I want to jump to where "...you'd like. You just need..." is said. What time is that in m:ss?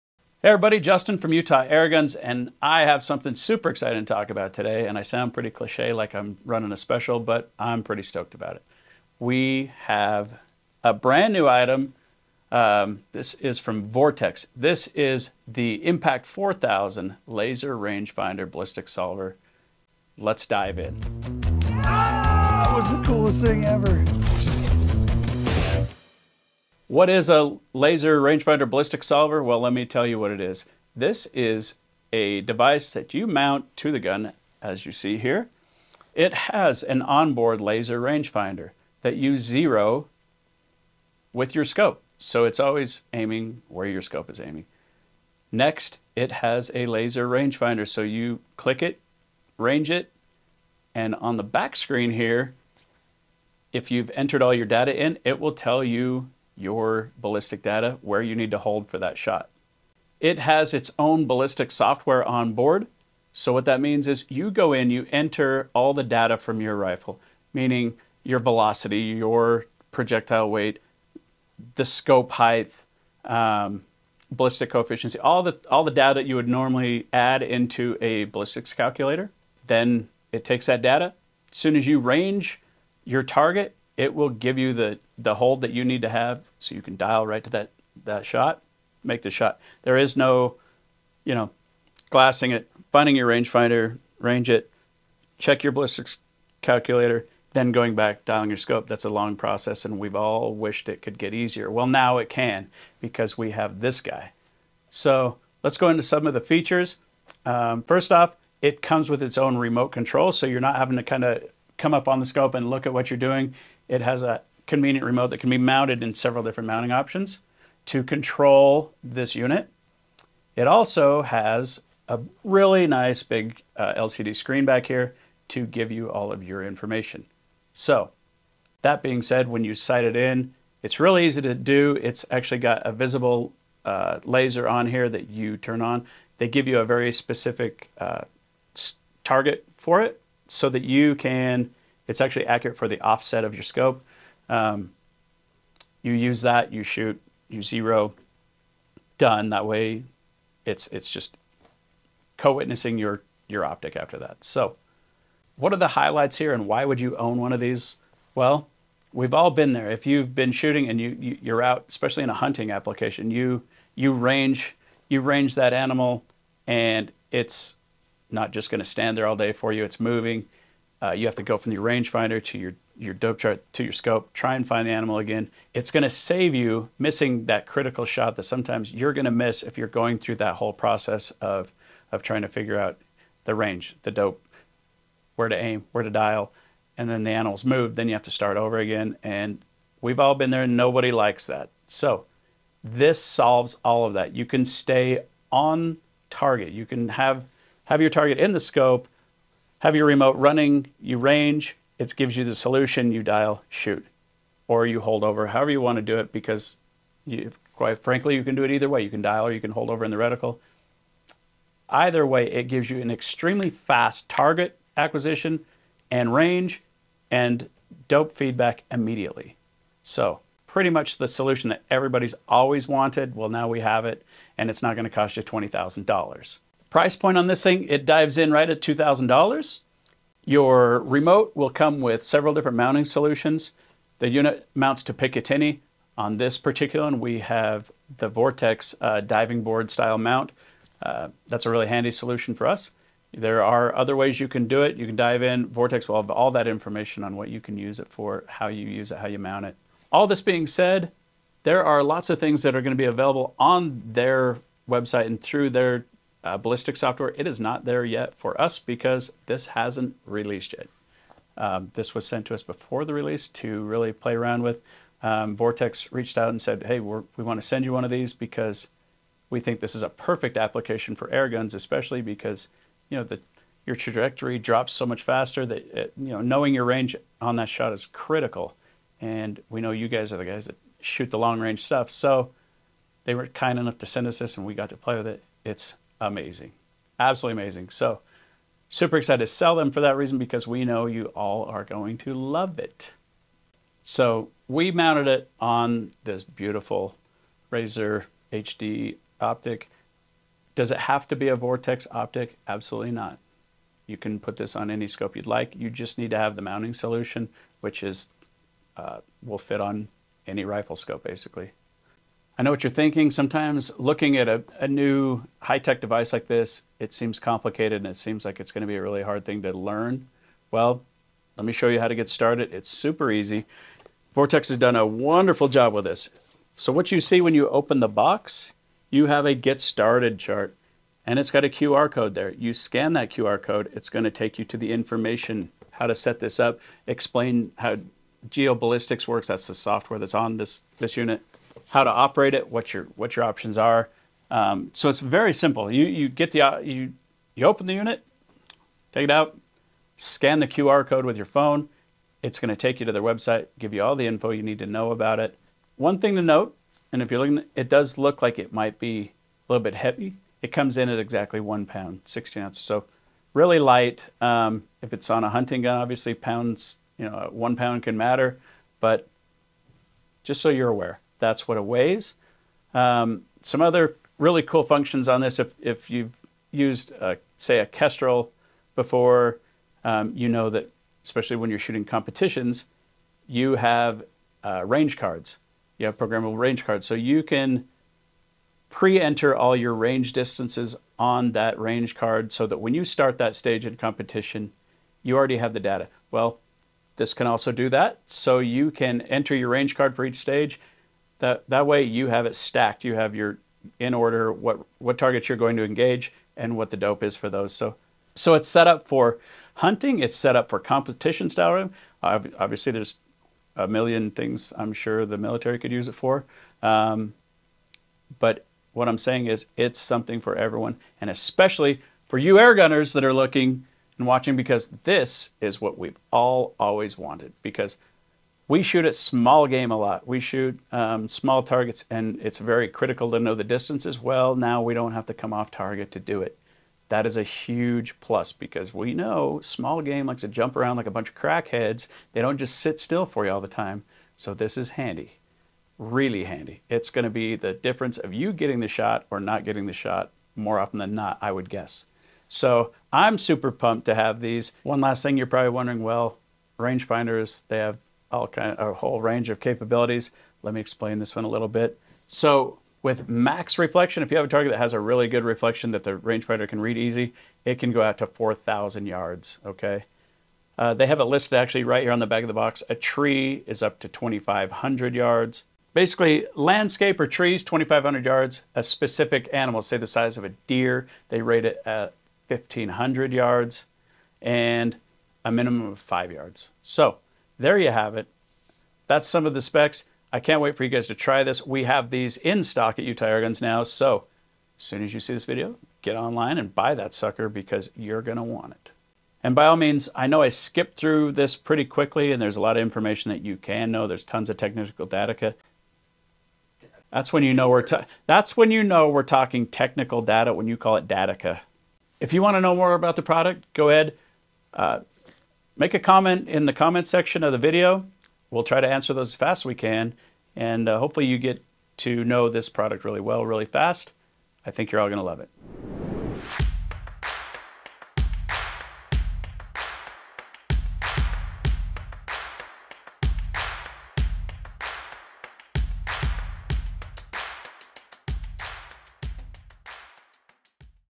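5:05.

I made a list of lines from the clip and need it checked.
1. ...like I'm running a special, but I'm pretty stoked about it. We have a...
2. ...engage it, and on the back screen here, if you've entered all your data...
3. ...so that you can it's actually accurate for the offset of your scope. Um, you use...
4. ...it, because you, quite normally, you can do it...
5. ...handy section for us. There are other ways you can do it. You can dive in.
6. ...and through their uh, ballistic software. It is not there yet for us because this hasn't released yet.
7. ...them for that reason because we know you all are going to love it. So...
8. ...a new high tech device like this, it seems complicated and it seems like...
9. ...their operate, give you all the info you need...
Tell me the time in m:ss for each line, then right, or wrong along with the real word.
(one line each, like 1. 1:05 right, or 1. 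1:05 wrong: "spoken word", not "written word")
1. 0:05 right
2. 0:49 wrong: "range", not "engage"
3. 2:20 right
4. 3:26 wrong: "frankly", not "normally"
5. 4:01 wrong: "solution", not "section"
6. 4:15 right
7. 4:49 right
8. 5:14 right
9. 5:53 wrong: "website", not "operate".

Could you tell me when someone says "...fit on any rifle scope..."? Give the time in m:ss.
5:09.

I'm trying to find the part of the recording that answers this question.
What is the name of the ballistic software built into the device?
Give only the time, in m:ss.
5:38.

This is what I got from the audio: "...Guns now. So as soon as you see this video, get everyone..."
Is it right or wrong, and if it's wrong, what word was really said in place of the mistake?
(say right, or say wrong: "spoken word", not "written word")
wrong: "online", not "everyone".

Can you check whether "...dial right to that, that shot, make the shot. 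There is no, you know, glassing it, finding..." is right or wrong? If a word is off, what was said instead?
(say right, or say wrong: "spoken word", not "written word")
right.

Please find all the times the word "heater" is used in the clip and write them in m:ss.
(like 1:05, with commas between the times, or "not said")
not said.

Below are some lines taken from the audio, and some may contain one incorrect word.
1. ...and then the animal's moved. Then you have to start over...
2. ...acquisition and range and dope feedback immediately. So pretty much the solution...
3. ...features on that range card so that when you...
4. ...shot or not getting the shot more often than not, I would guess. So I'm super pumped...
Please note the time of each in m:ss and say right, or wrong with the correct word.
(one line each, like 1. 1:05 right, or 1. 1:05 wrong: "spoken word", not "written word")
1. 3:06 right
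2. 3:34 right
3. 6:30 wrong: "distances", not "features"
4. 7:28 right.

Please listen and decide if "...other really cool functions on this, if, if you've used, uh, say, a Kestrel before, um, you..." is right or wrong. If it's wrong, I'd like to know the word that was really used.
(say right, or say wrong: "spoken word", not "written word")
right.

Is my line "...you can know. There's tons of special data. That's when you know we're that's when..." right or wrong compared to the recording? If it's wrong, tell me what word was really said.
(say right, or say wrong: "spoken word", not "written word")
wrong: "technical", not "special".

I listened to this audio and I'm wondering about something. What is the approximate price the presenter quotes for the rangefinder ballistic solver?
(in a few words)
$2,000.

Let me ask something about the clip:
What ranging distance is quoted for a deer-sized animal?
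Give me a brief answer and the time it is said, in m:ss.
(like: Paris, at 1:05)
1,500 yards, at 8:02.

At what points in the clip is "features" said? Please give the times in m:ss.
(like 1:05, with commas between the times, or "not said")
1:46.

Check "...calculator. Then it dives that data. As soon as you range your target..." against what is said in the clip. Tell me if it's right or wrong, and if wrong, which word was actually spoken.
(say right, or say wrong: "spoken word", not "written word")
wrong: "takes", not "dives".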